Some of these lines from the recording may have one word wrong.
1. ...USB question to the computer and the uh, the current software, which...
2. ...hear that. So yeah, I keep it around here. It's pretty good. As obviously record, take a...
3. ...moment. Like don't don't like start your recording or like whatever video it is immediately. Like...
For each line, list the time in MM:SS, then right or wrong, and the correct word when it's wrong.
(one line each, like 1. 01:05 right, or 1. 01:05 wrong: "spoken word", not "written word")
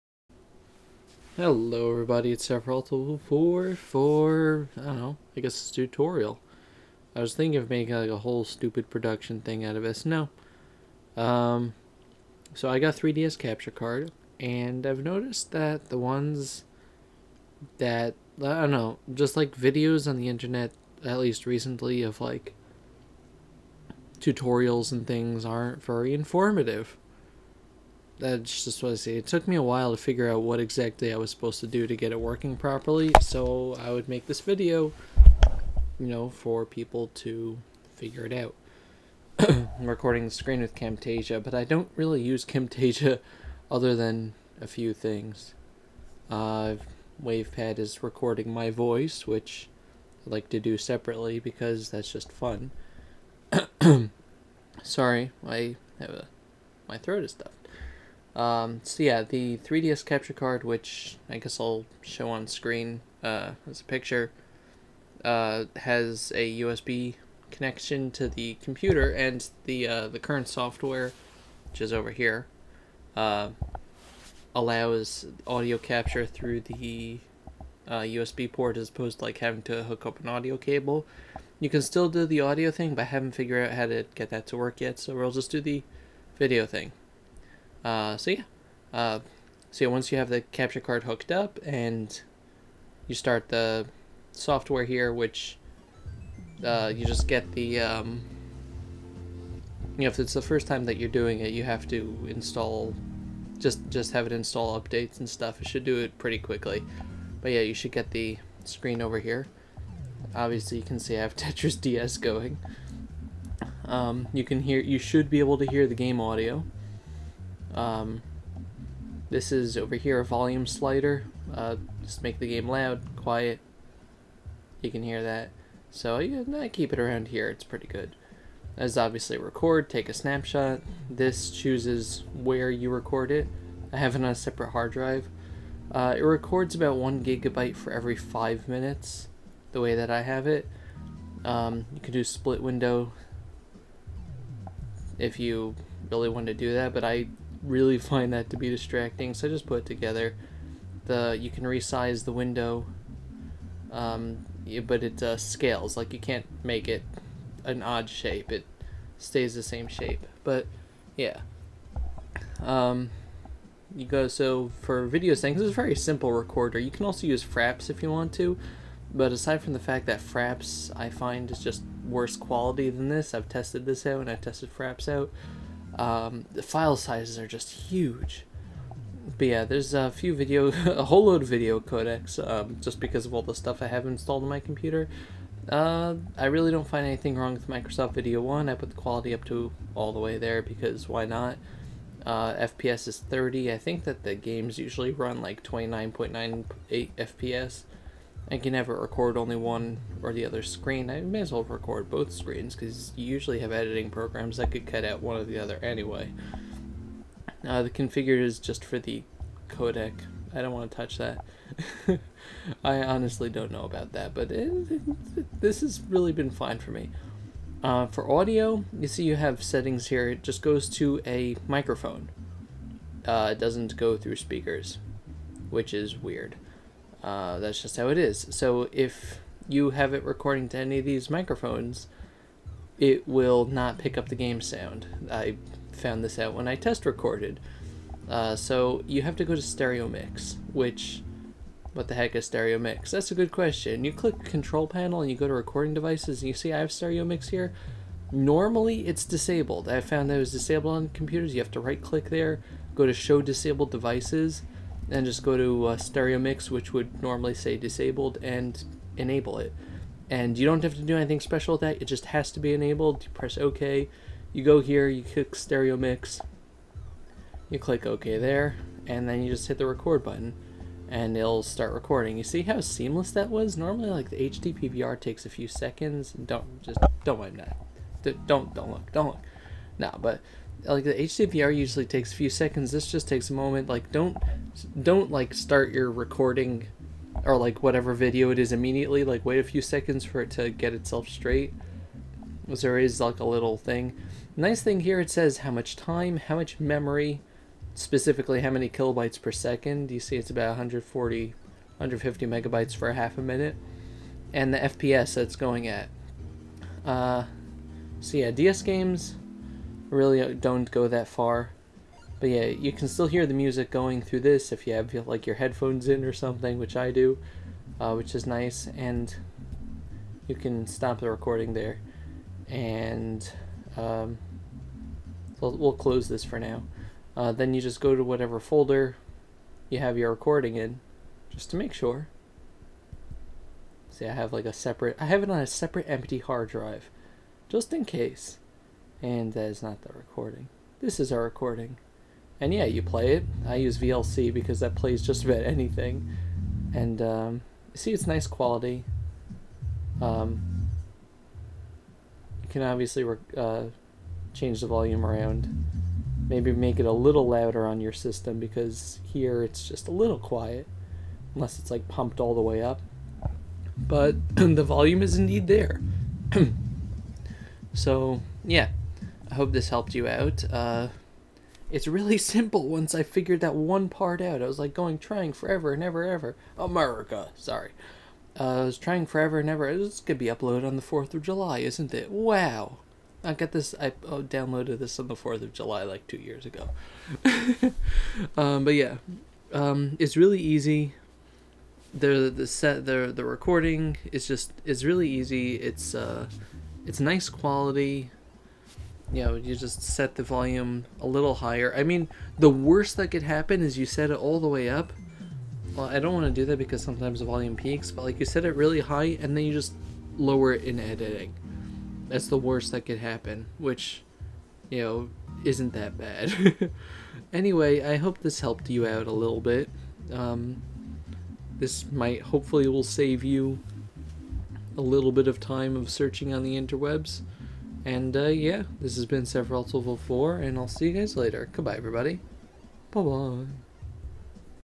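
1. 01:06 wrong: "connection", not "question"
2. 02:05 right
3. 04:43 right.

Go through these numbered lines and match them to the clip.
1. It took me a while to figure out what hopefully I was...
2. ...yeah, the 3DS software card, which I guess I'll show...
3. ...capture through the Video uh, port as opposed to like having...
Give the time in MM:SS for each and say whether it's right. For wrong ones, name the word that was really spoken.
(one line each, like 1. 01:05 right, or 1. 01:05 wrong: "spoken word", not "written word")
1. 00:29 wrong: "exactly", not "hopefully"
2. 00:59 wrong: "capture", not "software"
3. 01:15 wrong: "USB", not "Video".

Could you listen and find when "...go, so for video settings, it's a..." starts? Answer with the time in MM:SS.
02:44.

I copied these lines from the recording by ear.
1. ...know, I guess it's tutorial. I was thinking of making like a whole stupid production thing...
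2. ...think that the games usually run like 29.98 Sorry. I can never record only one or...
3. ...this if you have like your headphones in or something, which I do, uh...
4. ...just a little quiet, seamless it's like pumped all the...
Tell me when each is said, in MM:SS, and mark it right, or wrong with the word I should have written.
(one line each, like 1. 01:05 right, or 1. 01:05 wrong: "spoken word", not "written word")
1. 00:04 right
2. 03:13 wrong: "FPS", not "Sorry"
3. 05:14 right
4. 05:59 wrong: "unless", not "seamless".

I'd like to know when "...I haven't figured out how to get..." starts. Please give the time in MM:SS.
01:23.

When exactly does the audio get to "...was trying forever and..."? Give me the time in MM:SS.
06:18.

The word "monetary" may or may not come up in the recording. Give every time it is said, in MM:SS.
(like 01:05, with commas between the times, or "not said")
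not said.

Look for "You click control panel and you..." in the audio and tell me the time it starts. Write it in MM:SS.
04:04.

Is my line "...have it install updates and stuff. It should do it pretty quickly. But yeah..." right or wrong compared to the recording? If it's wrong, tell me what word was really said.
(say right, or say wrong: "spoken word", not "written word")
right.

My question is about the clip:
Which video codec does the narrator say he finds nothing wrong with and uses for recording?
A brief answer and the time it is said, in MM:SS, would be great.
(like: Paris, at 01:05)
Microsoft Video 1, at 03:07.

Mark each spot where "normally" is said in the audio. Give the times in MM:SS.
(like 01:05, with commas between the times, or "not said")
04:08, 04:17, 04:33.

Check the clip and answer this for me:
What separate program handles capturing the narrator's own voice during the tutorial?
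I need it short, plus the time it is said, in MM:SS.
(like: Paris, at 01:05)
WavePad, at 00:47.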